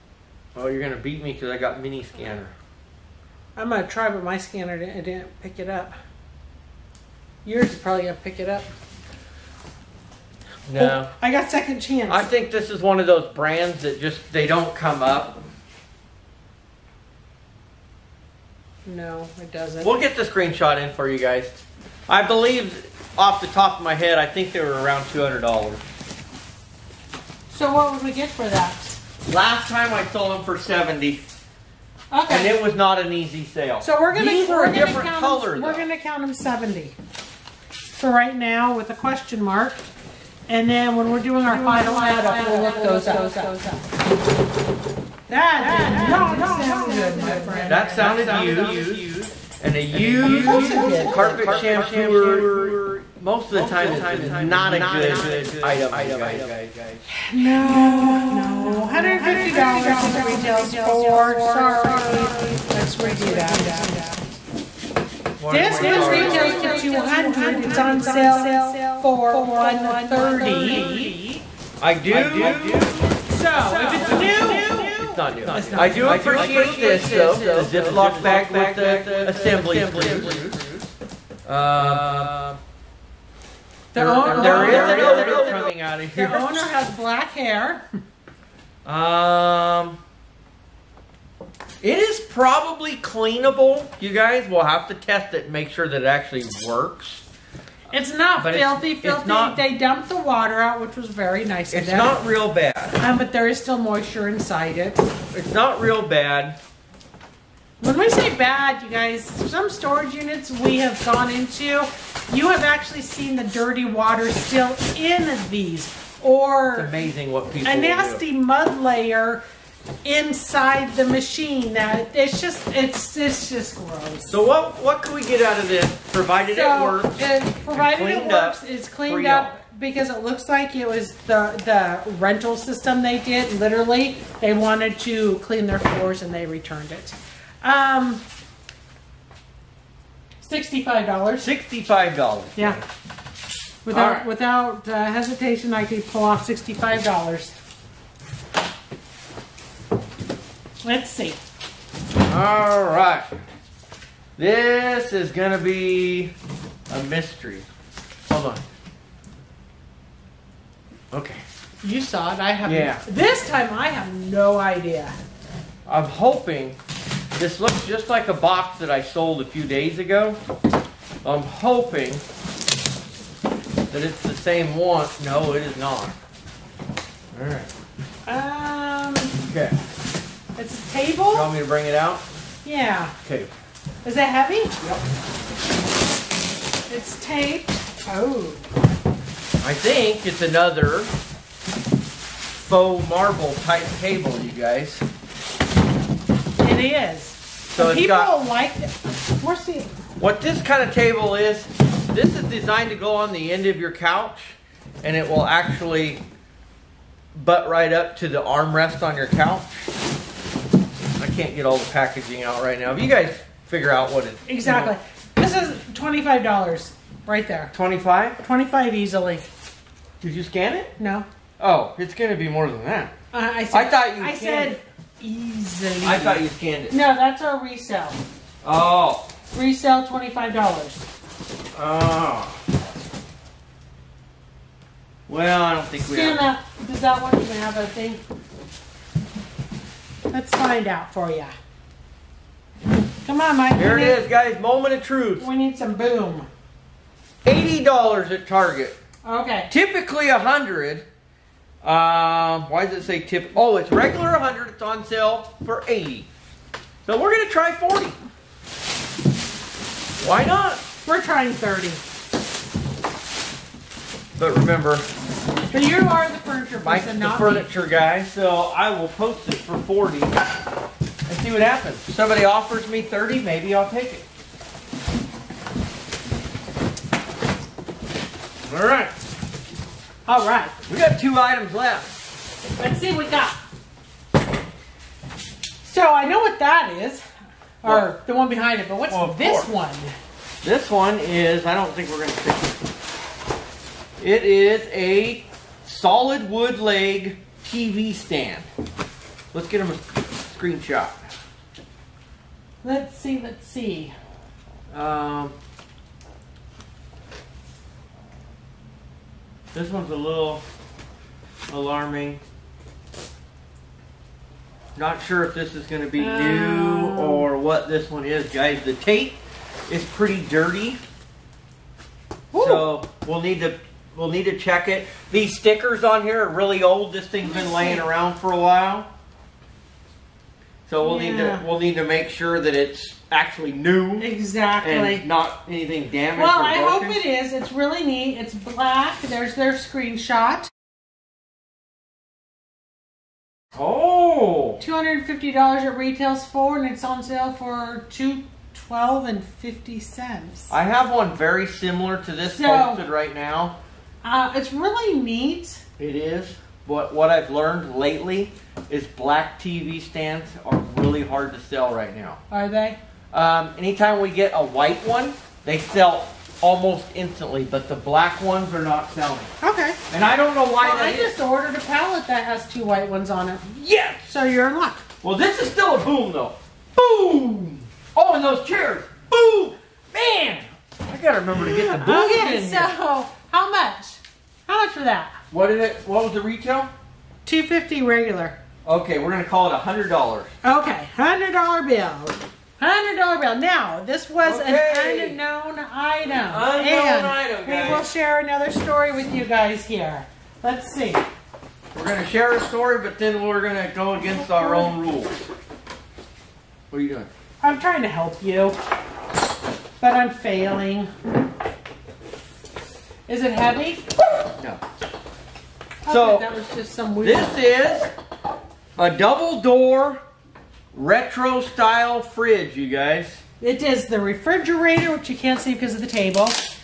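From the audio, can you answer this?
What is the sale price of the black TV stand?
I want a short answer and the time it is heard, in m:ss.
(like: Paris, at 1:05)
$212.50, at 5:48.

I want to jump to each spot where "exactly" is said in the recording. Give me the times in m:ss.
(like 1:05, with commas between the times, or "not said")
3:34, 5:34.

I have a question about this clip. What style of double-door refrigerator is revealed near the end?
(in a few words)
retro.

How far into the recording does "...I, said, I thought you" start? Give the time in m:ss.
3:43.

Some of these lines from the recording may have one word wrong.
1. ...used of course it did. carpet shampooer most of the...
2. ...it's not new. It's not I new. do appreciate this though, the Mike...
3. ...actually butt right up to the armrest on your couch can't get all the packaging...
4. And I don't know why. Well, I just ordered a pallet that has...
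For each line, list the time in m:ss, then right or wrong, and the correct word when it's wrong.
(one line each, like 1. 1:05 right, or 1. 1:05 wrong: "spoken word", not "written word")
1. 0:49 right
2. 1:14 wrong: "Ziploc", not "Mike"
3. 3:25 right
4. 6:10 right.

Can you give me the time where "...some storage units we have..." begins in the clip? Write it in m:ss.
1:49.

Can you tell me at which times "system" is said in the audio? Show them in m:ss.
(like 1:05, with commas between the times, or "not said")
2:12.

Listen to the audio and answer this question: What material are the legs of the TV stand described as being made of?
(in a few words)
solid wood.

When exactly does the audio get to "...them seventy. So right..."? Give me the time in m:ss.
0:36.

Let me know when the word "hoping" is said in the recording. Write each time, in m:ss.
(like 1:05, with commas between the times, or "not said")
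2:46, 2:51.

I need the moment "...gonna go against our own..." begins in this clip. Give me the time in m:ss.
6:43.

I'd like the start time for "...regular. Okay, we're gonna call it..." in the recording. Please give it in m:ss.
6:28.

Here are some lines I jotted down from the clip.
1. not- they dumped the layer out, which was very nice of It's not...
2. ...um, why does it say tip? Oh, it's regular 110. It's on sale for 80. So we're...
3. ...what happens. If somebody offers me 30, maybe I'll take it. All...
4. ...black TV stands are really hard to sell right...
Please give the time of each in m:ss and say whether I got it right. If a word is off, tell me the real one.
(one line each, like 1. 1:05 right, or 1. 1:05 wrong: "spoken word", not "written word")
1. 1:39 wrong: "water", not "layer"
2. 4:11 wrong: "100", not "110"
3. 4:31 right
4. 5:59 right.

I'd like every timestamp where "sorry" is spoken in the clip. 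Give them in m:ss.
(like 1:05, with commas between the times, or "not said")
1:01, 1:05.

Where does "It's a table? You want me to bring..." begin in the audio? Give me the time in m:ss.
3:00.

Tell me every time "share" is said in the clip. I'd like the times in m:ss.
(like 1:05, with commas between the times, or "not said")
6:38, 6:42.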